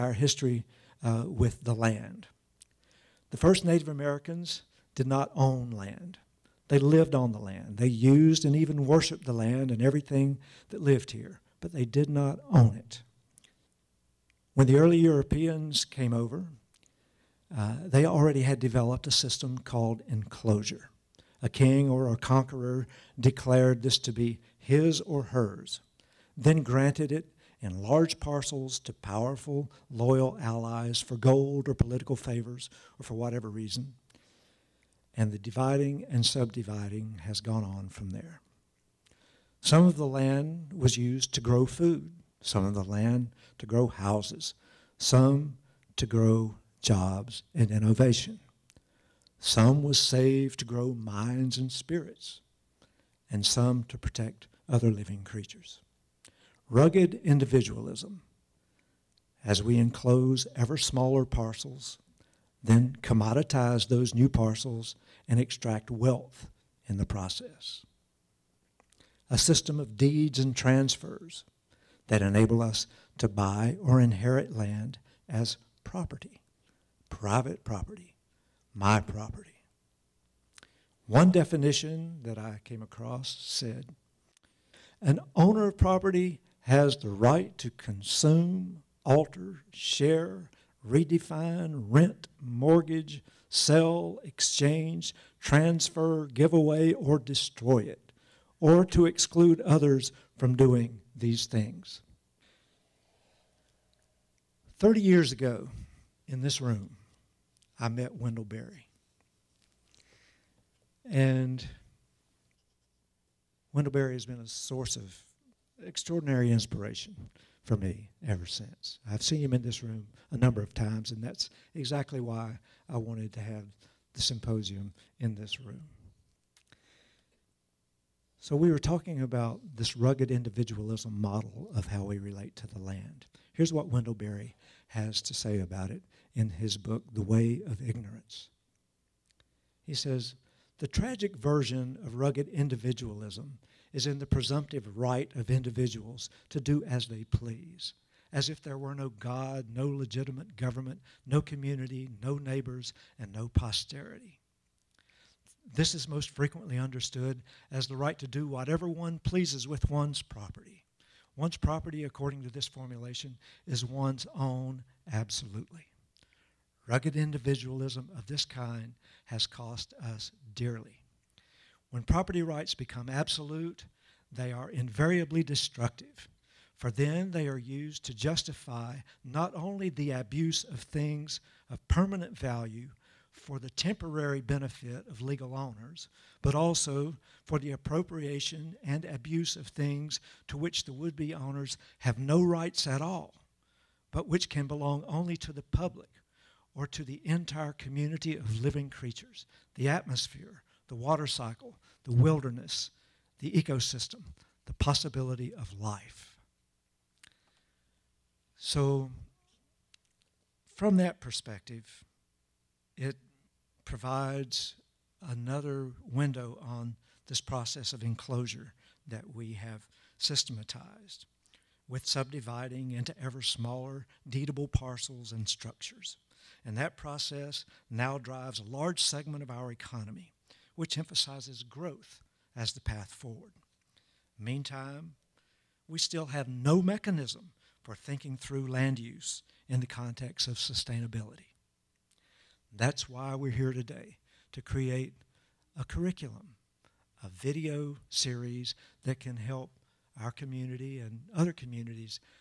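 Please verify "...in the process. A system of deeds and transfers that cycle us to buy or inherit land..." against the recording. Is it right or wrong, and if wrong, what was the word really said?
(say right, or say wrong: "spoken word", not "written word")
wrong: "enable", not "cycle".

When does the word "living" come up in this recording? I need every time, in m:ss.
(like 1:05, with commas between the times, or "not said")
0:54, 3:18.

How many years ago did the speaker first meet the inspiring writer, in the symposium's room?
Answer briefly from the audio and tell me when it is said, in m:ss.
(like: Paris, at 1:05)
30, at 1:44.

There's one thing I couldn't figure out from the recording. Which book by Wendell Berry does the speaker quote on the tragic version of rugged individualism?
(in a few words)
The Way of Ignorance.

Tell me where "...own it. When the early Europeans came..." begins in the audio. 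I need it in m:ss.
0:12.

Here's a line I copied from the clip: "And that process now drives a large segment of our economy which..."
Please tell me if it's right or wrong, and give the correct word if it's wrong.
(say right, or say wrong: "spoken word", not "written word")
right.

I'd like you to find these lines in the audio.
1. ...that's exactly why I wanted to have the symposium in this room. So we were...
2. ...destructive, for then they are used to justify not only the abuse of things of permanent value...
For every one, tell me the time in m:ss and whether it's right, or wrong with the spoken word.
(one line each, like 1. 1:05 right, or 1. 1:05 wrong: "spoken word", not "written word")
1. 2:01 right
2. 2:55 right.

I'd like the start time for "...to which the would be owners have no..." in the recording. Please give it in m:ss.
3:10.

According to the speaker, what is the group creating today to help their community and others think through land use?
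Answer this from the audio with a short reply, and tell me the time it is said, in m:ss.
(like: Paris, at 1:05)
A video series, at 4:07.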